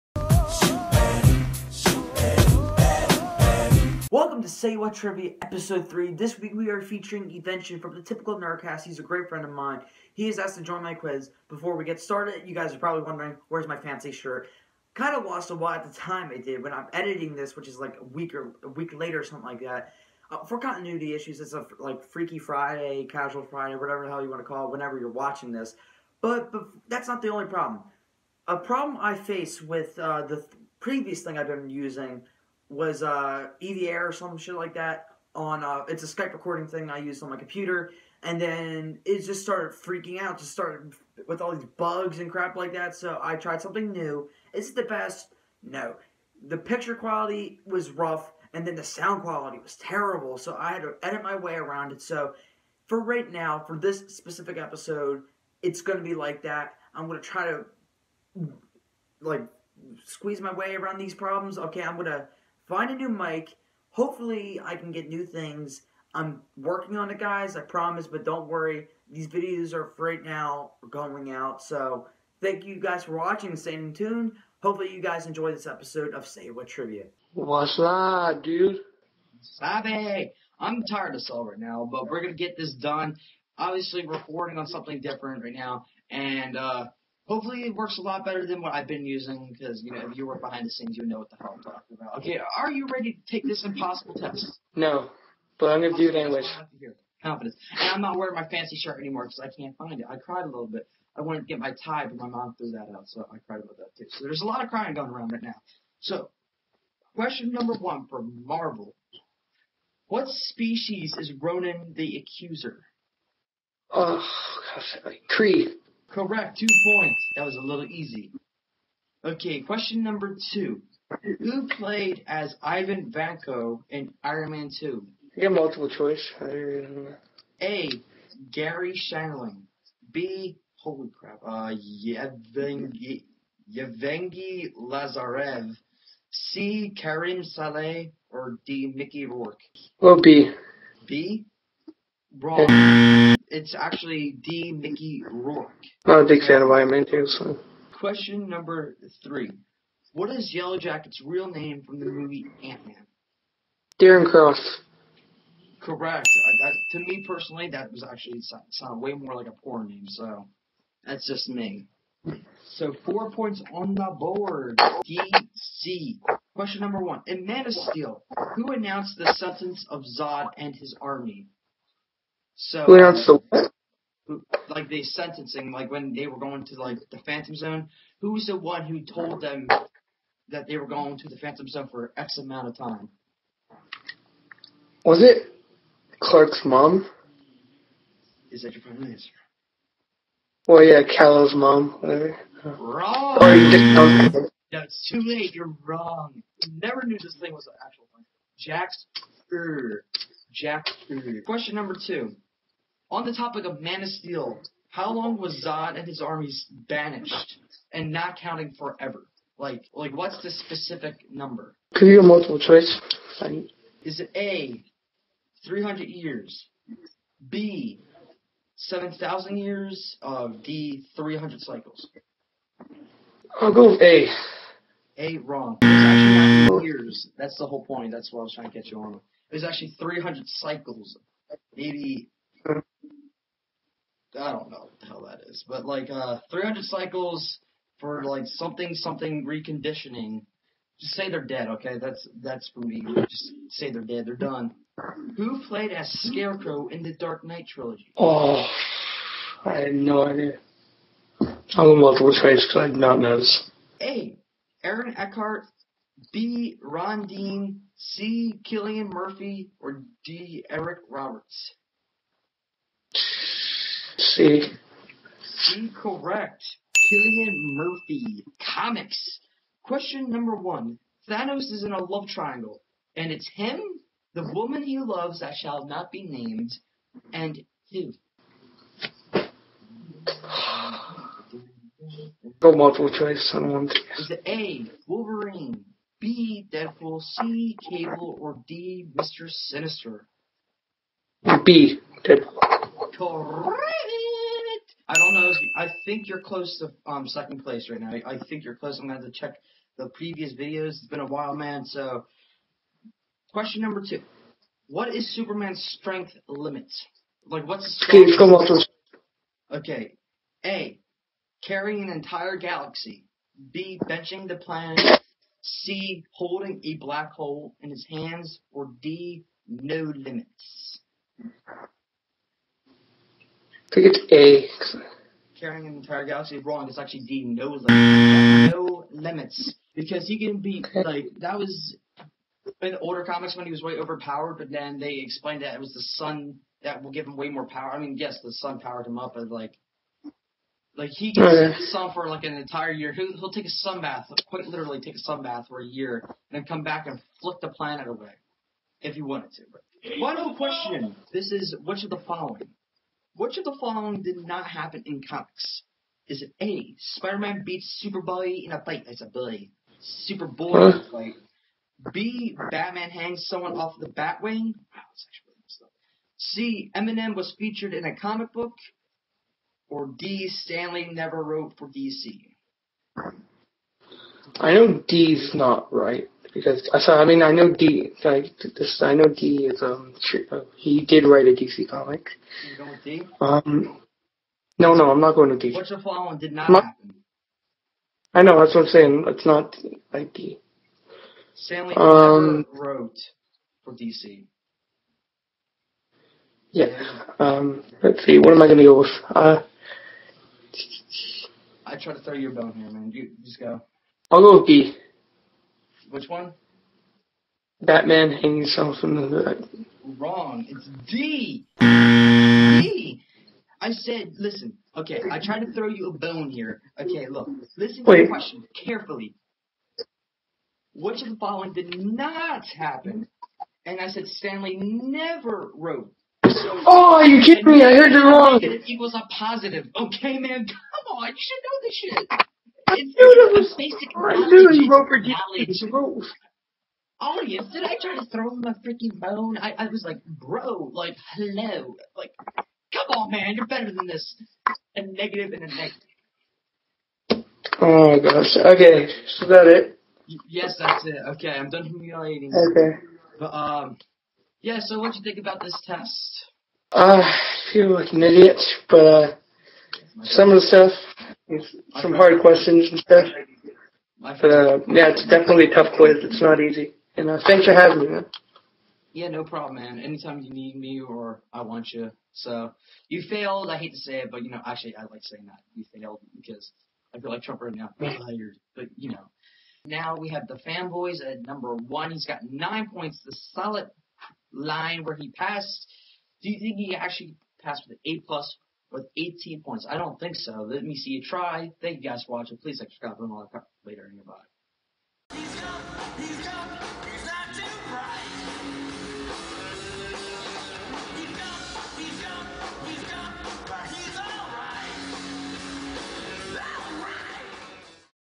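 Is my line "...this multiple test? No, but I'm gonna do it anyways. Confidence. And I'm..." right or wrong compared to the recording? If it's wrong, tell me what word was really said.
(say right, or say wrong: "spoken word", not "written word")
wrong: "impossible", not "multiple".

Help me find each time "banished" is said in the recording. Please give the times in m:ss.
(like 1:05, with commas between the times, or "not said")
3:26.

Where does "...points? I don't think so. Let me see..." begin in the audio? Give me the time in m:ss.
8:09.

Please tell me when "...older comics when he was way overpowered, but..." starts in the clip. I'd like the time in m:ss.
5:33.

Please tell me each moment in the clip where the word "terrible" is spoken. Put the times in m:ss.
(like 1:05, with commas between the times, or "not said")
0:49.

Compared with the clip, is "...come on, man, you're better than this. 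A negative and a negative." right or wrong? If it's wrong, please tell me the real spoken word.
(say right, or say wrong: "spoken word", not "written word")
right.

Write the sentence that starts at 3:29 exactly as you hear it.
Like, like what's the specific number?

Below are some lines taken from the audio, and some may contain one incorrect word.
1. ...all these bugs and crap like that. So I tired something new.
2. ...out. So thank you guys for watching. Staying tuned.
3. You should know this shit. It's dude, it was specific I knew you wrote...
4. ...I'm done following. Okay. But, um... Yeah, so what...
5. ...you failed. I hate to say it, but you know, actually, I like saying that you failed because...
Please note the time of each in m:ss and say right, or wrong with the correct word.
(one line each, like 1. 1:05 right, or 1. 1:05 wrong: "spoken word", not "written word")
1. 0:41 wrong: "tried", not "tired"
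2. 1:11 right
3. 7:11 wrong: "basic", not "specific"
4. 7:31 wrong: "humiliating", not "following"
5. 7:53 right.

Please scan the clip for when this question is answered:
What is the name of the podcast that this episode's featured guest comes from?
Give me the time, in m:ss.
0:08.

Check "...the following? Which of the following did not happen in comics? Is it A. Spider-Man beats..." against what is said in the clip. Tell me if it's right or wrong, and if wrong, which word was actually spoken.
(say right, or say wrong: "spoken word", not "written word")
right.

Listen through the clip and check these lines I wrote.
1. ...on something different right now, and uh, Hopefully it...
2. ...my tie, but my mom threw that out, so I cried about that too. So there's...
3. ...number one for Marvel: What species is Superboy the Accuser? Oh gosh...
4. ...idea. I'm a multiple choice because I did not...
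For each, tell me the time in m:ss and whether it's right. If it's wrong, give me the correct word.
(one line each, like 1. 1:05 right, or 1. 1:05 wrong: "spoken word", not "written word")
1. 1:24 right
2. 1:41 right
3. 1:47 wrong: "Ronan", not "Superboy"
4. 4:10 right.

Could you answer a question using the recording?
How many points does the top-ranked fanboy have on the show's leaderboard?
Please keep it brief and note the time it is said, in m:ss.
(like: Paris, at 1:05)
9, at 8:02.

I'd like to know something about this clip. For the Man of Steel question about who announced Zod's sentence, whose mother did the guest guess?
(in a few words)
Clark's mom.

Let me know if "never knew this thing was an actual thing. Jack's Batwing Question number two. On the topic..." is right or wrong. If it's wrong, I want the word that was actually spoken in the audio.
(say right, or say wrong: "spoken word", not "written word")
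wrong: "Jack", not "Batwing".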